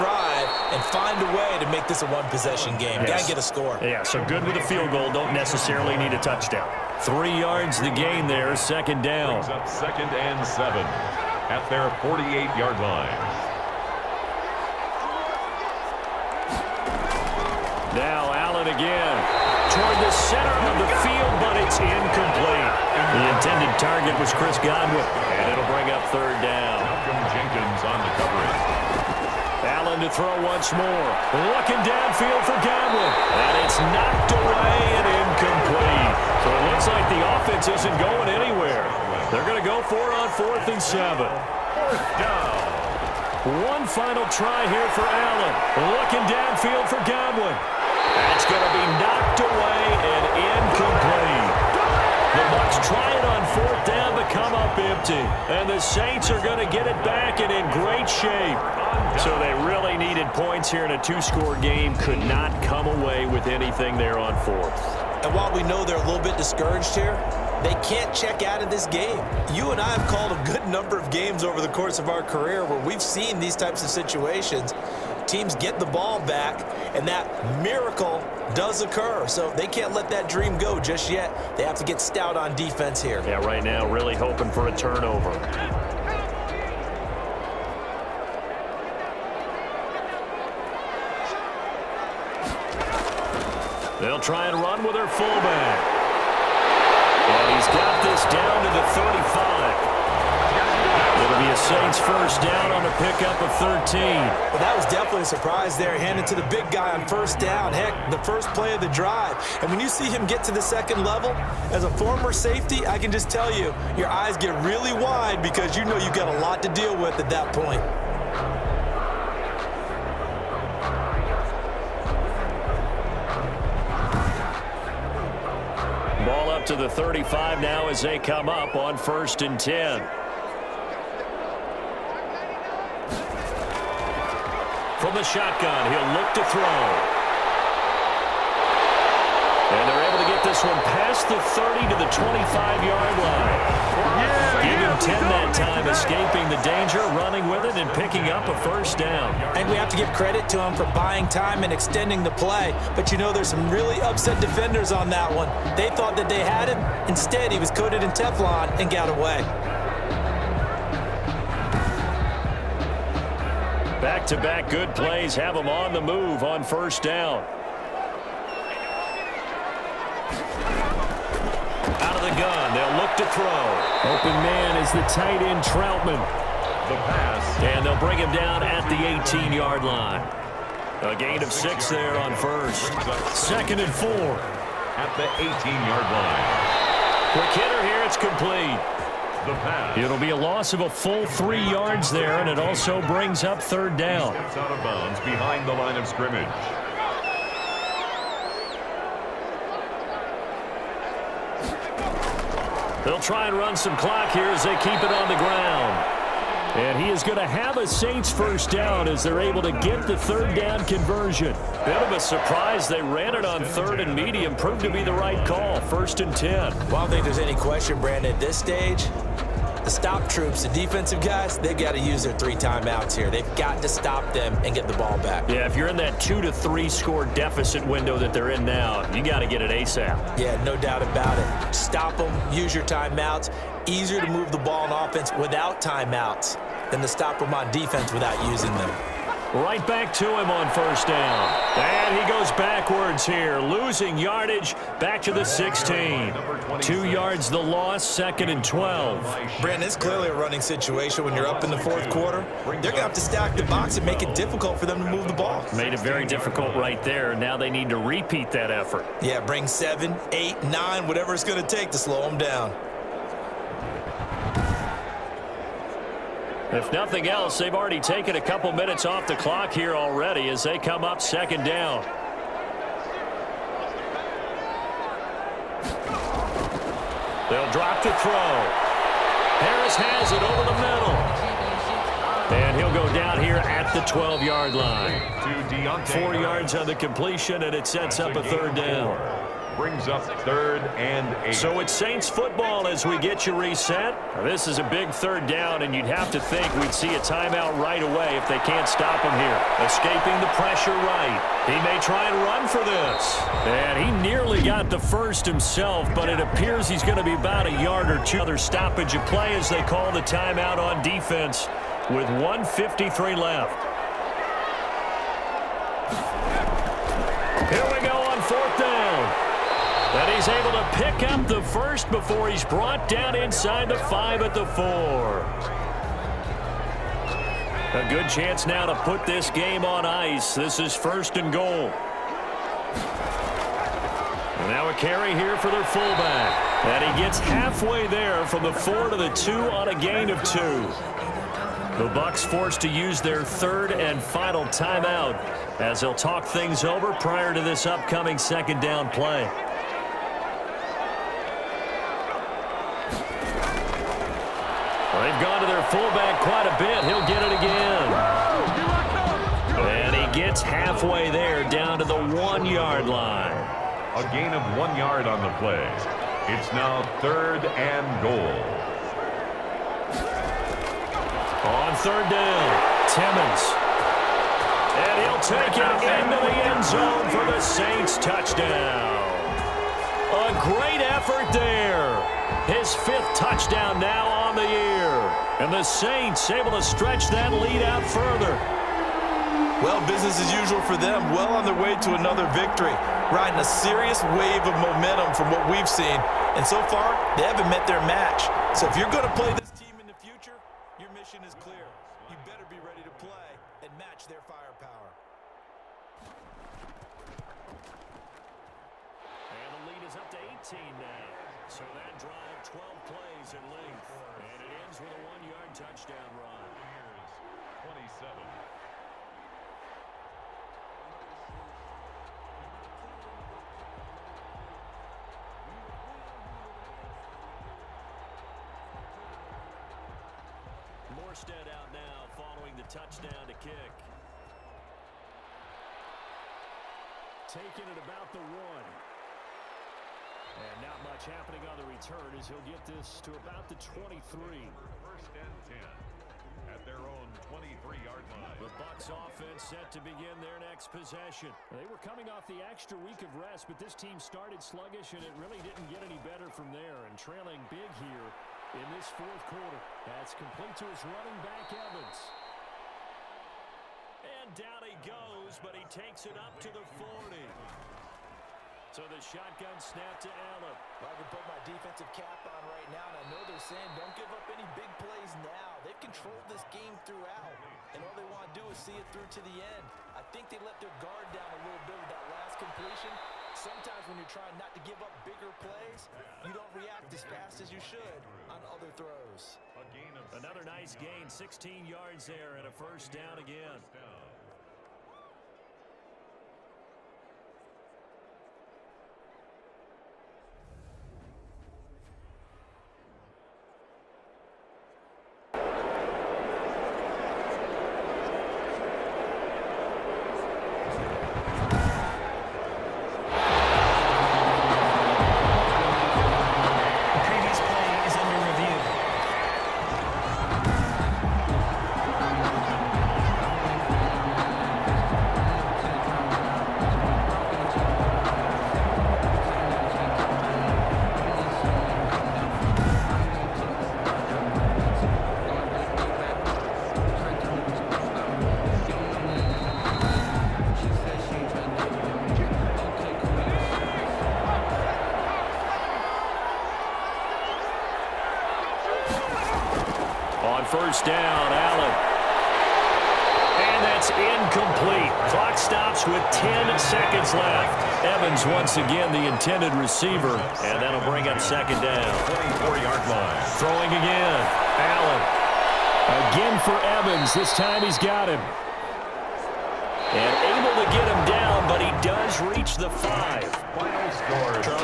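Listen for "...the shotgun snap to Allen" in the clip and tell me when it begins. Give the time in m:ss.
7:49.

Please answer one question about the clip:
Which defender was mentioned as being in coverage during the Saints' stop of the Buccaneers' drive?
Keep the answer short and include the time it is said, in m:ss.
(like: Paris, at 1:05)
Malcolm Jenkins, at 0:26.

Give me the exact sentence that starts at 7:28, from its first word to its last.
The Bucks offense set to begin their next possession.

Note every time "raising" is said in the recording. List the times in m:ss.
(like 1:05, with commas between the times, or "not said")
not said.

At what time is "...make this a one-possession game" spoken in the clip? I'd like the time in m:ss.
0:01.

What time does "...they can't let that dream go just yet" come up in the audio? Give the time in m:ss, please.
1:19.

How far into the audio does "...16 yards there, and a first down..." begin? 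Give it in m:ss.
8:11.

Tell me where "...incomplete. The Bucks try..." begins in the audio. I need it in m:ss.
0:50.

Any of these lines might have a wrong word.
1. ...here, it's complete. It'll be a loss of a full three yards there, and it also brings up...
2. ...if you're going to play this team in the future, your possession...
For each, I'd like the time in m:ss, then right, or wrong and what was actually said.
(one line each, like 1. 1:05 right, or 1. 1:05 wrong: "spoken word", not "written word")
1. 3:07 right
2. 6:38 wrong: "mission", not "possession".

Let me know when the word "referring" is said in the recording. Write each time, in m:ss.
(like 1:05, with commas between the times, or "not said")
not said.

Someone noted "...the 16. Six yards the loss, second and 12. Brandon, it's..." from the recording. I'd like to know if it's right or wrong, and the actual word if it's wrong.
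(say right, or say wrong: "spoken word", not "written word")
wrong: "Two", not "Six".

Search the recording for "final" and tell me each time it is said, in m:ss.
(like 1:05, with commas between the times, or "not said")
0:43, 5:44.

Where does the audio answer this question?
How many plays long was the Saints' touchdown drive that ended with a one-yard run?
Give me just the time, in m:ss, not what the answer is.
6:52.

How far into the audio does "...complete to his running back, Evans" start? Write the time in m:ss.
7:40.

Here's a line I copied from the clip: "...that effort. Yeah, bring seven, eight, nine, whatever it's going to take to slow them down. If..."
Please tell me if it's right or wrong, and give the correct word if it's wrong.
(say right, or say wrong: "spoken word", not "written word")
right.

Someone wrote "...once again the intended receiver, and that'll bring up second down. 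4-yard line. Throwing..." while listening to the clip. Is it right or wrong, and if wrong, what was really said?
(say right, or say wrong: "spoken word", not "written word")
right.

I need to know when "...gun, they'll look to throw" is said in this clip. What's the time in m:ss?
2:52.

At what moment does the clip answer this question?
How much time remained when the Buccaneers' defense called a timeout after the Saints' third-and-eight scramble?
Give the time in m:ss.
5:12.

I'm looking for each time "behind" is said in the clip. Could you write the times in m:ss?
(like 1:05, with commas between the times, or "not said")
3:15.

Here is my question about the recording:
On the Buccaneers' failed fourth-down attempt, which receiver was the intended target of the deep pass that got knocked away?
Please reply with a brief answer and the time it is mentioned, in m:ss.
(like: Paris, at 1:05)
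Chris Godwin, at 0:24.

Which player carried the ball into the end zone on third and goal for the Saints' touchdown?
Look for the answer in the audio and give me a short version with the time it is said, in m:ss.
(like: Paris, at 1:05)
Timmons, at 6:13.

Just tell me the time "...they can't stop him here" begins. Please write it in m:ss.
4:58.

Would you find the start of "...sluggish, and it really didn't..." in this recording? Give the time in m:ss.
7:34.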